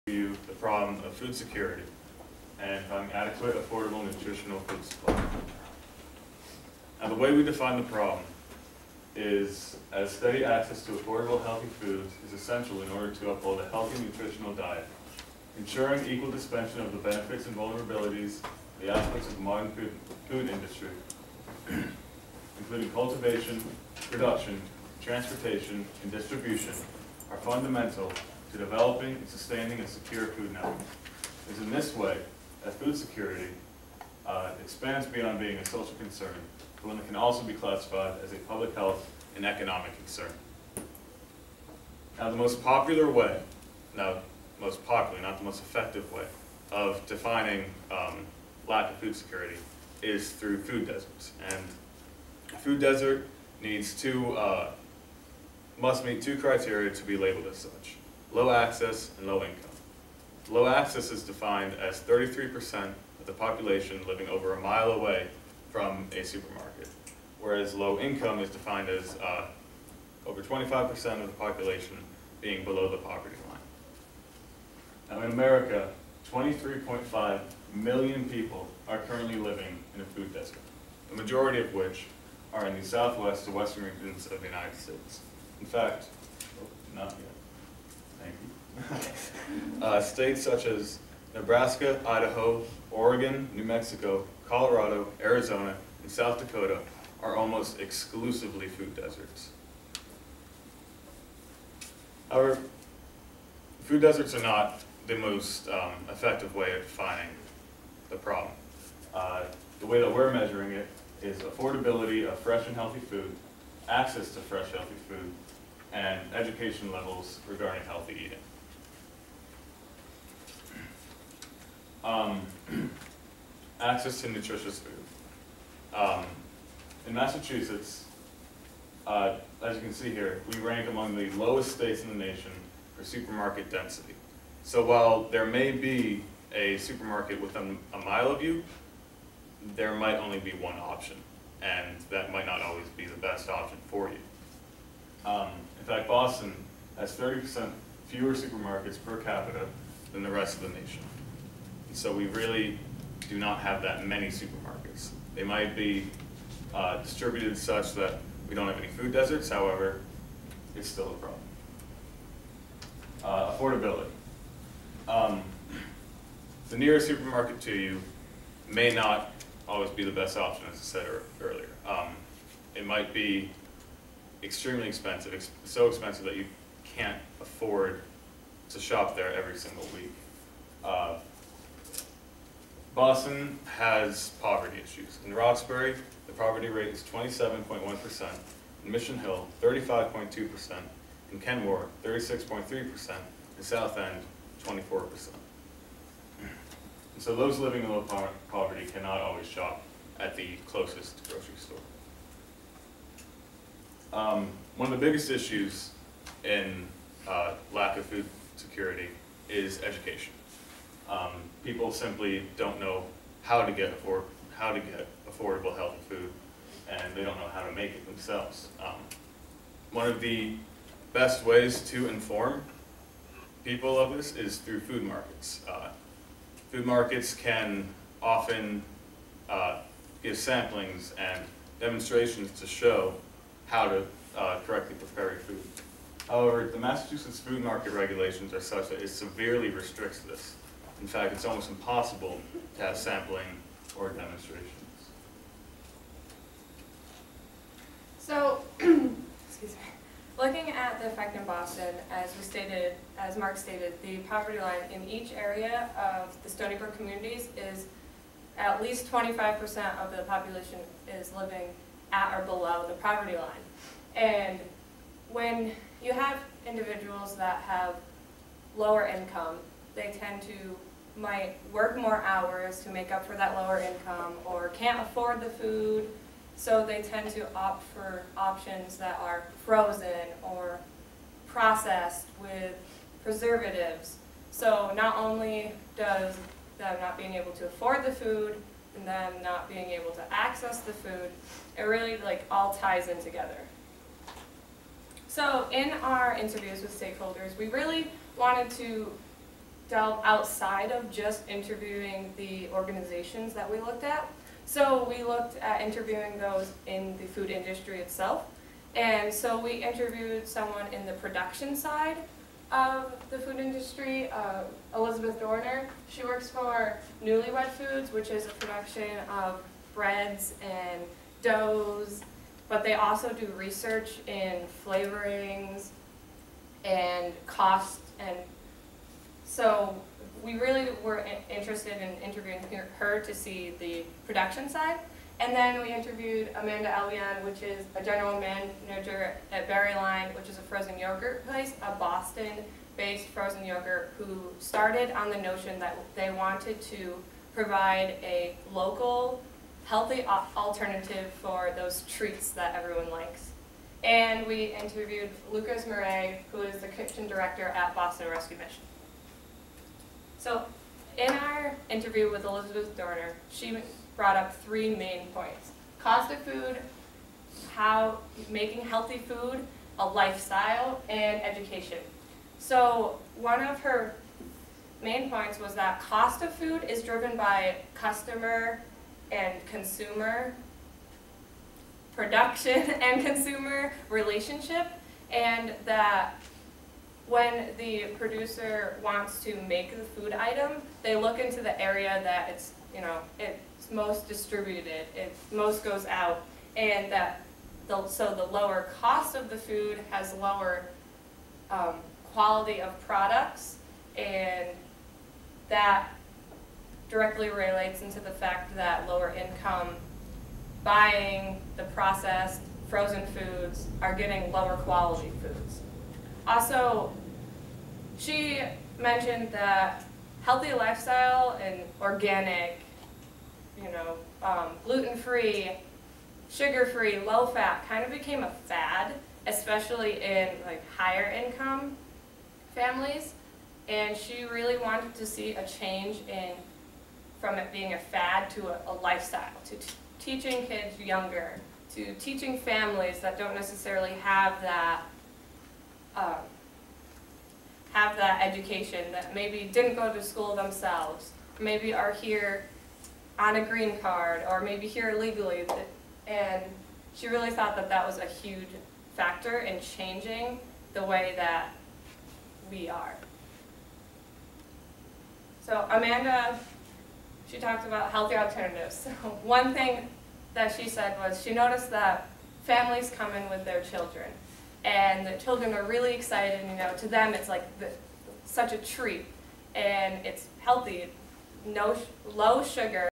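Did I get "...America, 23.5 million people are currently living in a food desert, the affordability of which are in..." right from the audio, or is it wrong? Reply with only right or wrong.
wrong.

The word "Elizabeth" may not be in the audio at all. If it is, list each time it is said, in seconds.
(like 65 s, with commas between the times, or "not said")
314 s, 362 s.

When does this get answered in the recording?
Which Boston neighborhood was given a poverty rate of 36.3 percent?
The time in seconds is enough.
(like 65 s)
191 s.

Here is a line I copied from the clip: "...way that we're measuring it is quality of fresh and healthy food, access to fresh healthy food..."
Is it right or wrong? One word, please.
wrong.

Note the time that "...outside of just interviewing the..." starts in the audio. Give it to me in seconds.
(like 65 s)
300 s.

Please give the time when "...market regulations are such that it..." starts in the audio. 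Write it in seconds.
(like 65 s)
237 s.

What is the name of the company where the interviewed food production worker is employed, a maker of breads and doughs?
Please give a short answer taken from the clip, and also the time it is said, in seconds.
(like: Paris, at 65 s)
Newly Weds Foods, at 317 s.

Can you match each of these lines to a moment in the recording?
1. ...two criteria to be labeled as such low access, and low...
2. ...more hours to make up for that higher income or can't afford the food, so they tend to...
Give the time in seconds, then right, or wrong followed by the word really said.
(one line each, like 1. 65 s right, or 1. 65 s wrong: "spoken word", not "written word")
1. 56 s right
2. 271 s wrong: "lower", not "higher".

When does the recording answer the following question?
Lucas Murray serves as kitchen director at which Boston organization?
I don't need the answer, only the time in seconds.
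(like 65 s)
357 s.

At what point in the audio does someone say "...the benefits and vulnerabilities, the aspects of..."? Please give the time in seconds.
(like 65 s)
16 s.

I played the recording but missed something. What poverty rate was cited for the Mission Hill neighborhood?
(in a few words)
35.2%.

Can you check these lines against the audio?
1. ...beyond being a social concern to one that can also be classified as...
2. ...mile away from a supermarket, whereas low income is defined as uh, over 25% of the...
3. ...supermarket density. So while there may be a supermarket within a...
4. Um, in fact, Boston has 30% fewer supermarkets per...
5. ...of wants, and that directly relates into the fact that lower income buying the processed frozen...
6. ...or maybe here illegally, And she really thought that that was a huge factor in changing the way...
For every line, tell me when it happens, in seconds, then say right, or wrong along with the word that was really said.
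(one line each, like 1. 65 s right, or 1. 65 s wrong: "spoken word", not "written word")
1. 35 s right
2. 64 s right
3. 133 s right
4. 145 s right
5. 402 s wrong: "products", not "wants"
6. 454 s right.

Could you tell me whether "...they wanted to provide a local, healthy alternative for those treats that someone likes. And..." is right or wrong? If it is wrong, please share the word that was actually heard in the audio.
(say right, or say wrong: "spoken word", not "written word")
wrong: "everyone", not "someone".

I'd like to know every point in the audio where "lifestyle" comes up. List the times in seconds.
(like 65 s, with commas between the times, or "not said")
370 s, 420 s, 439 s.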